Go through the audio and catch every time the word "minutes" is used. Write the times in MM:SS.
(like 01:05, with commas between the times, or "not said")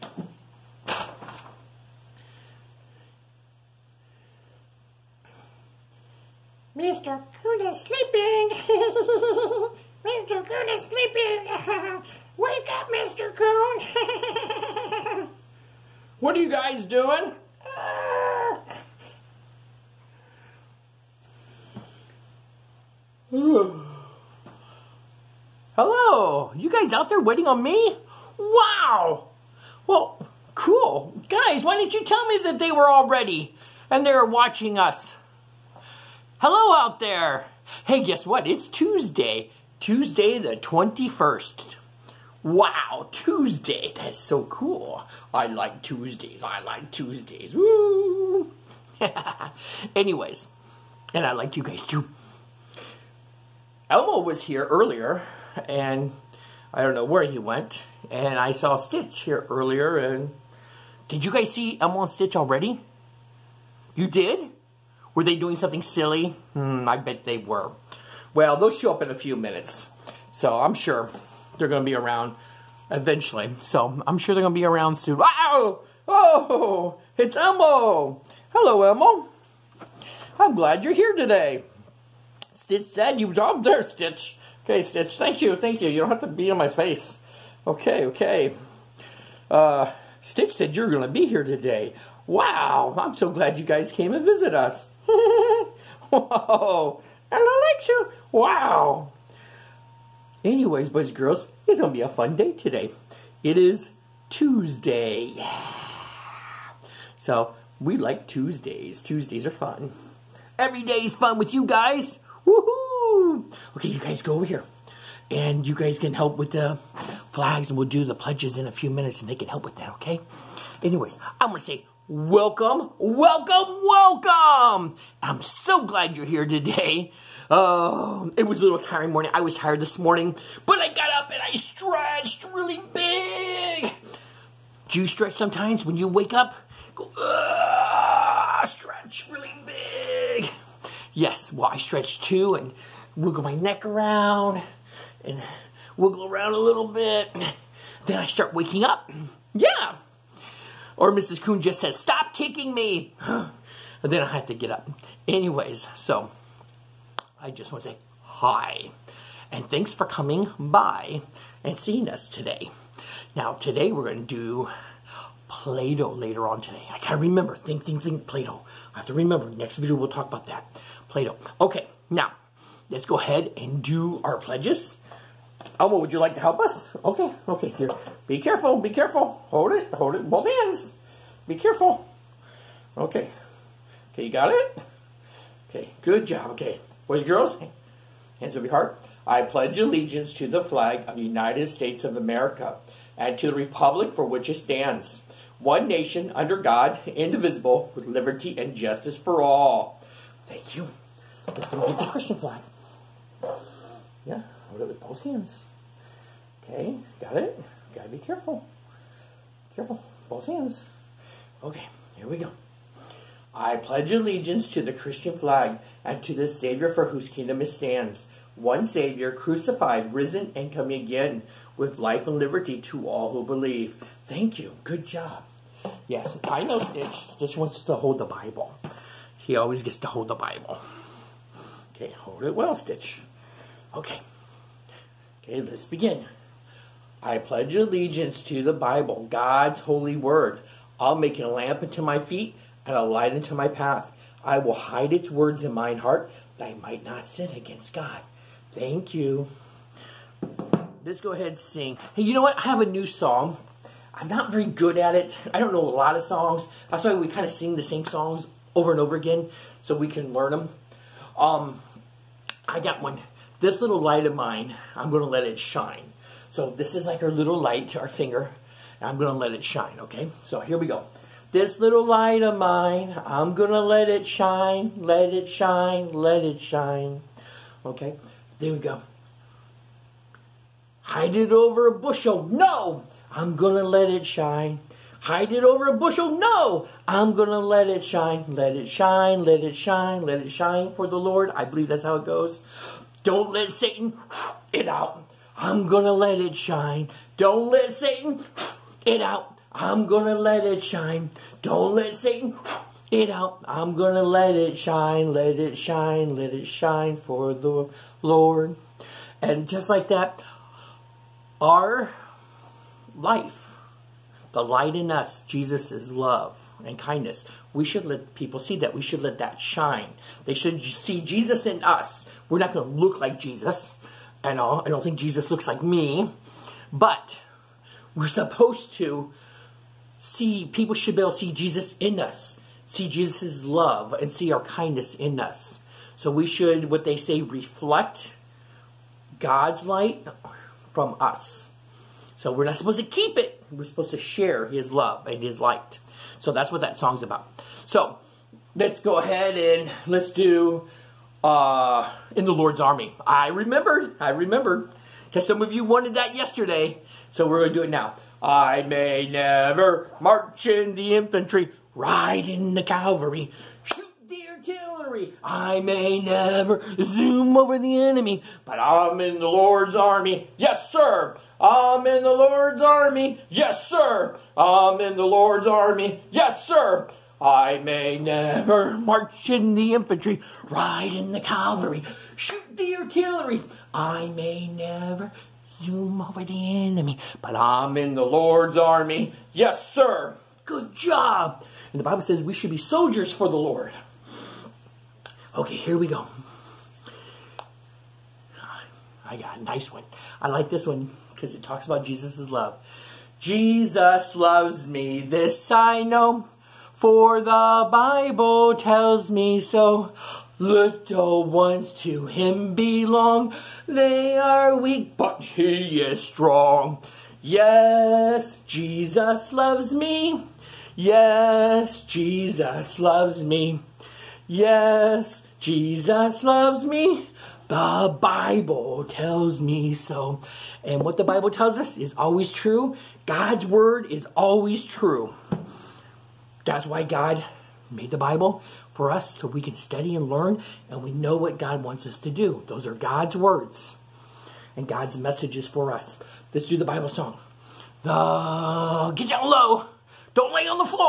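01:09, 01:58.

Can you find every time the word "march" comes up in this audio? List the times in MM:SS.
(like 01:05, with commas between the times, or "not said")
06:00, 06:18.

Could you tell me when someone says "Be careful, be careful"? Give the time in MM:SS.
02:58.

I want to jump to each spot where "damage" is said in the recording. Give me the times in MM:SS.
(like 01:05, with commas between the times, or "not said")
not said.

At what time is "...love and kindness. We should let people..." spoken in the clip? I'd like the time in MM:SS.
05:16.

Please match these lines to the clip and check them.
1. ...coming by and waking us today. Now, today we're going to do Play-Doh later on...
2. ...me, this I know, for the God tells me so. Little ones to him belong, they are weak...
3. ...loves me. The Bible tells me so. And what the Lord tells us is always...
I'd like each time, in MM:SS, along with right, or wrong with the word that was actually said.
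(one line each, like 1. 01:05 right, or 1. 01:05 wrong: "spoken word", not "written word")
1. 02:40 wrong: "seeing", not "waking"
2. 06:44 wrong: "Bible", not "God"
3. 07:06 wrong: "Bible", not "Lord".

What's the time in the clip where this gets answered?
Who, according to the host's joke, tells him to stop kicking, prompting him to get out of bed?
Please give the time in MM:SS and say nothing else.
02:31.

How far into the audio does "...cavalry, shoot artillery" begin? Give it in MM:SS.
06:02.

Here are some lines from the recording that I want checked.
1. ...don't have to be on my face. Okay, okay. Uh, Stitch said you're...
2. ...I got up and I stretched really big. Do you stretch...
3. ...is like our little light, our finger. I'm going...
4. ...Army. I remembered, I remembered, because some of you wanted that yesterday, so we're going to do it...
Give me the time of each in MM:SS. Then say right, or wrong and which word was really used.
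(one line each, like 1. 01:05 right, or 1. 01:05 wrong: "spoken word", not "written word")
1. 01:26 right
2. 02:10 right
3. 04:26 right
4. 05:52 right.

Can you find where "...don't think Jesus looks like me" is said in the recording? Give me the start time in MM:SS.
05:24.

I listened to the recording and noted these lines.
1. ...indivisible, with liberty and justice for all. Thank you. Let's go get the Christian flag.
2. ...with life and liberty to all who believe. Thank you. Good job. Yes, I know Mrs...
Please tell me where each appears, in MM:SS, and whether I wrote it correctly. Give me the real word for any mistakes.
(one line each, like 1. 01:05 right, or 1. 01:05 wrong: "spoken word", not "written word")
1. 03:17 right
2. 03:41 wrong: "Stitch", not "Mrs".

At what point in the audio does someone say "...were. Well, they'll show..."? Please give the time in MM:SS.
01:07.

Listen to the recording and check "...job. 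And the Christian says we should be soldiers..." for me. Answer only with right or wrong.
wrong.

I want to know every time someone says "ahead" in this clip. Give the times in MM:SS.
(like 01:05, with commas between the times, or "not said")
02:53, 04:11, 05:49.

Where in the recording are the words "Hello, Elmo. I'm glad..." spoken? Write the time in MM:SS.
01:18.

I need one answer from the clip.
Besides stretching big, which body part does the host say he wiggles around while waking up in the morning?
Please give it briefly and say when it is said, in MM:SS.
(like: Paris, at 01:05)
neck, at 02:23.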